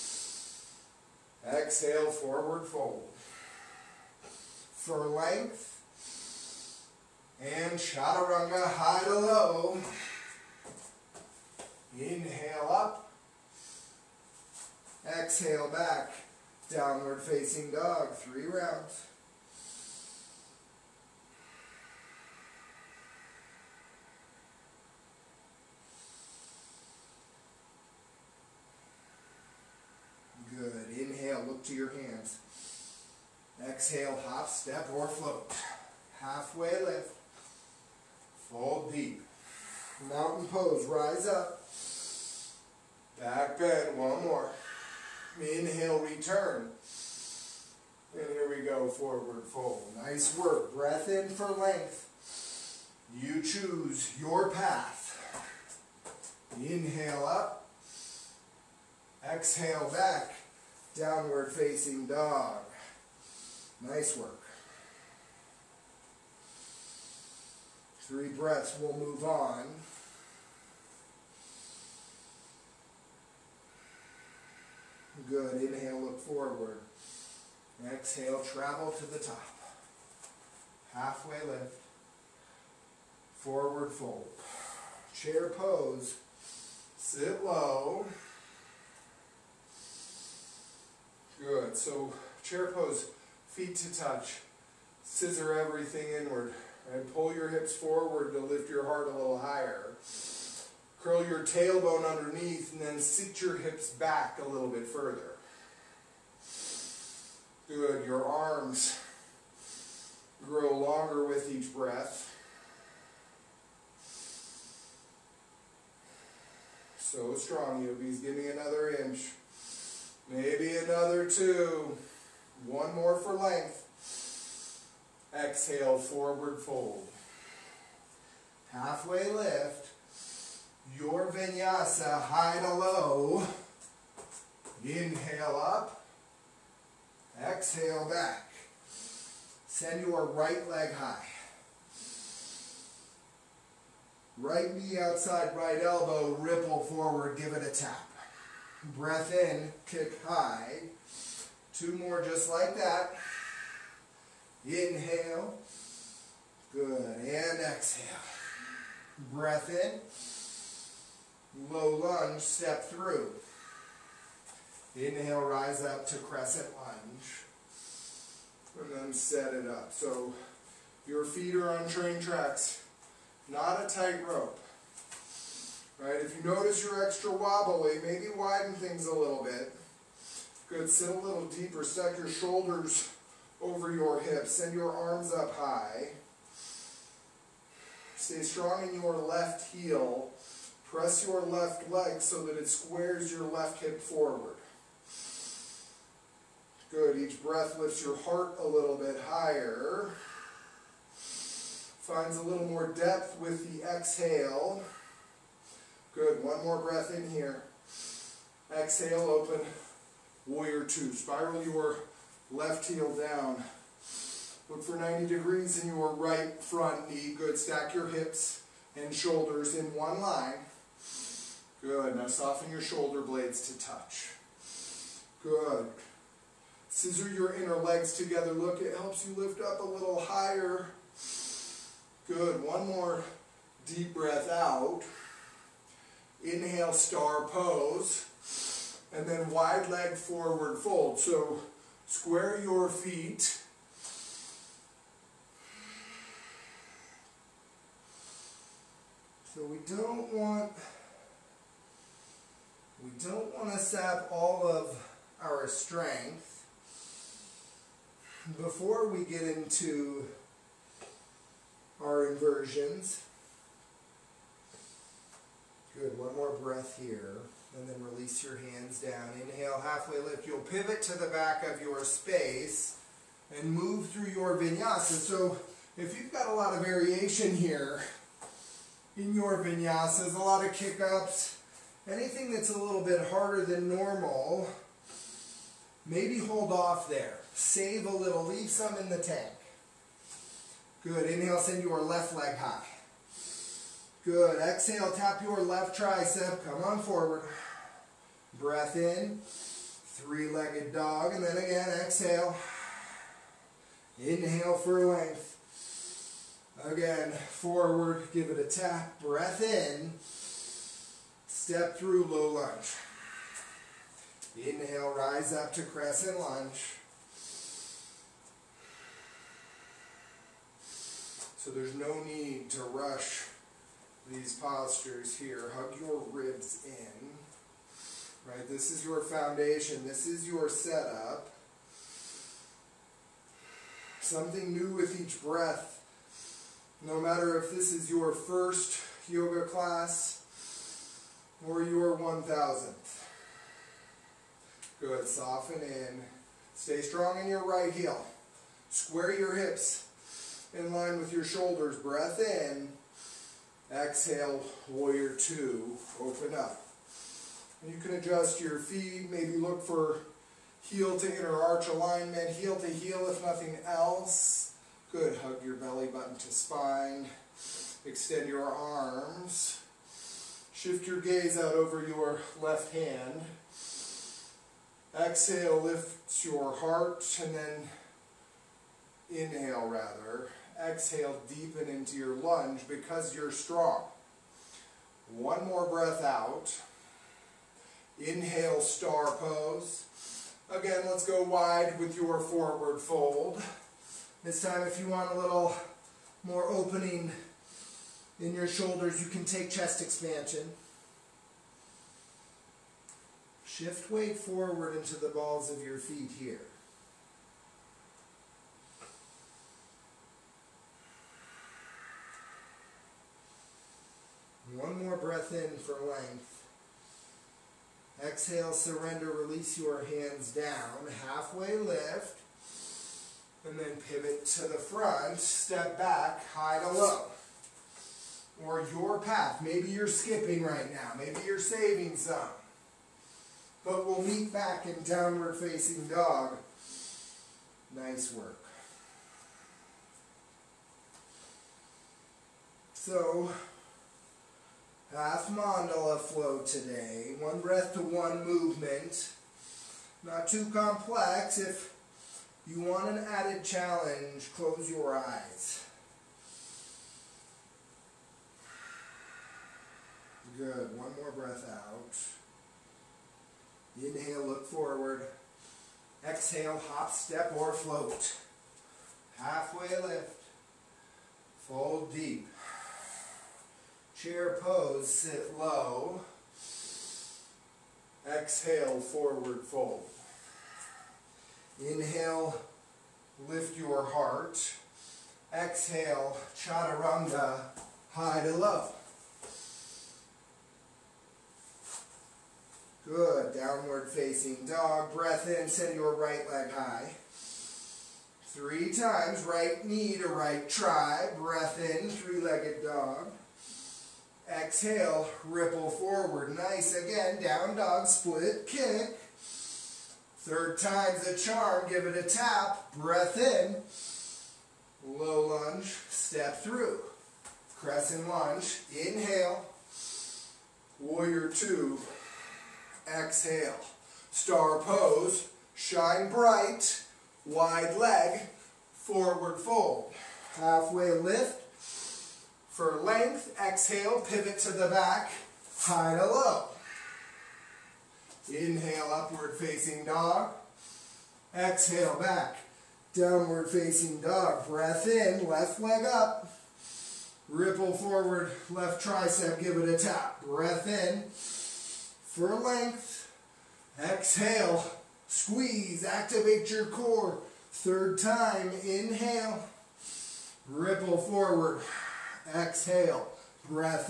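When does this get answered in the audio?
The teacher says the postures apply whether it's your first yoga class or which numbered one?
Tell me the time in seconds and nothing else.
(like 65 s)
342 s.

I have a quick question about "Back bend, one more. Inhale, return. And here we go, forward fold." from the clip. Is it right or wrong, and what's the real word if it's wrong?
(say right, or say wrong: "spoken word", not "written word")
right.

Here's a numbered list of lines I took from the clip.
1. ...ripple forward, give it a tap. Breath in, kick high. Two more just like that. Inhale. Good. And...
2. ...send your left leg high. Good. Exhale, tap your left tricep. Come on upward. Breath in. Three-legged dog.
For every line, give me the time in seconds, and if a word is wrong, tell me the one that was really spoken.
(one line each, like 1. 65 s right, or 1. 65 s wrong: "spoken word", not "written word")
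1. 146 s right
2. 291 s wrong: "forward", not "upward".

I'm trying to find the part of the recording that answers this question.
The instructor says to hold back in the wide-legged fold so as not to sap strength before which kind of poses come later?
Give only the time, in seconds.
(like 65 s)
262 s.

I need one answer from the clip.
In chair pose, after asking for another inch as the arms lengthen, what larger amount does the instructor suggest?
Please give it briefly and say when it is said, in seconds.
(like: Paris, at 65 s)
2, at 120 s.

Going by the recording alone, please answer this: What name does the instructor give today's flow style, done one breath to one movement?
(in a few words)
Half mandala flow.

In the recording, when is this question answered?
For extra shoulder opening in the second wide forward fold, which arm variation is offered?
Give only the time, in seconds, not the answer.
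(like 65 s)
399 s.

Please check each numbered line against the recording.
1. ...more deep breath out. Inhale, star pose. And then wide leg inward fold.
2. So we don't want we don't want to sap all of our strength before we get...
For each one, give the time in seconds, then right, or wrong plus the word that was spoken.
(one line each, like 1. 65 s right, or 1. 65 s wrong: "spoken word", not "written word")
1. 232 s wrong: "forward", not "inward"
2. 249 s right.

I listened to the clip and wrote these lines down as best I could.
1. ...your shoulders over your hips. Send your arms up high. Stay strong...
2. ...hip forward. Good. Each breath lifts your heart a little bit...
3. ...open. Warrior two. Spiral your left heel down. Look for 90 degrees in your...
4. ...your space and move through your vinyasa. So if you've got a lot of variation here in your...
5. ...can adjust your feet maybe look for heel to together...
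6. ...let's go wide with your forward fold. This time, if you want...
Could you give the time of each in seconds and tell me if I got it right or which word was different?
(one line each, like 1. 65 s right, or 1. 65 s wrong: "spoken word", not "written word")
1. 182 s right
2. 193 s right
3. 209 s right
4. 271 s right
5. 357 s wrong: "inner", not "together"
6. 391 s right.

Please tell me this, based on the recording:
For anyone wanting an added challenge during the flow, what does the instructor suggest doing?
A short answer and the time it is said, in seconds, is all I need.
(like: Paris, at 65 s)
Close your eyes, at 454 s.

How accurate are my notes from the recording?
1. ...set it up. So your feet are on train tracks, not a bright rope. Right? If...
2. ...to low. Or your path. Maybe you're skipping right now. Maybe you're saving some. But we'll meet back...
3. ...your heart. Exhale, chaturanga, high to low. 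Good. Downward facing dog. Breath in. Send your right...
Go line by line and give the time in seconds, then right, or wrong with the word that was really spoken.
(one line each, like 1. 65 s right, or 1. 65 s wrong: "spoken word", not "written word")
1. 169 s wrong: "tight", not "bright"
2. 426 s right
3. 483 s right.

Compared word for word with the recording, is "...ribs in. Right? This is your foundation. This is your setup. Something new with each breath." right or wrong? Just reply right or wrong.
right.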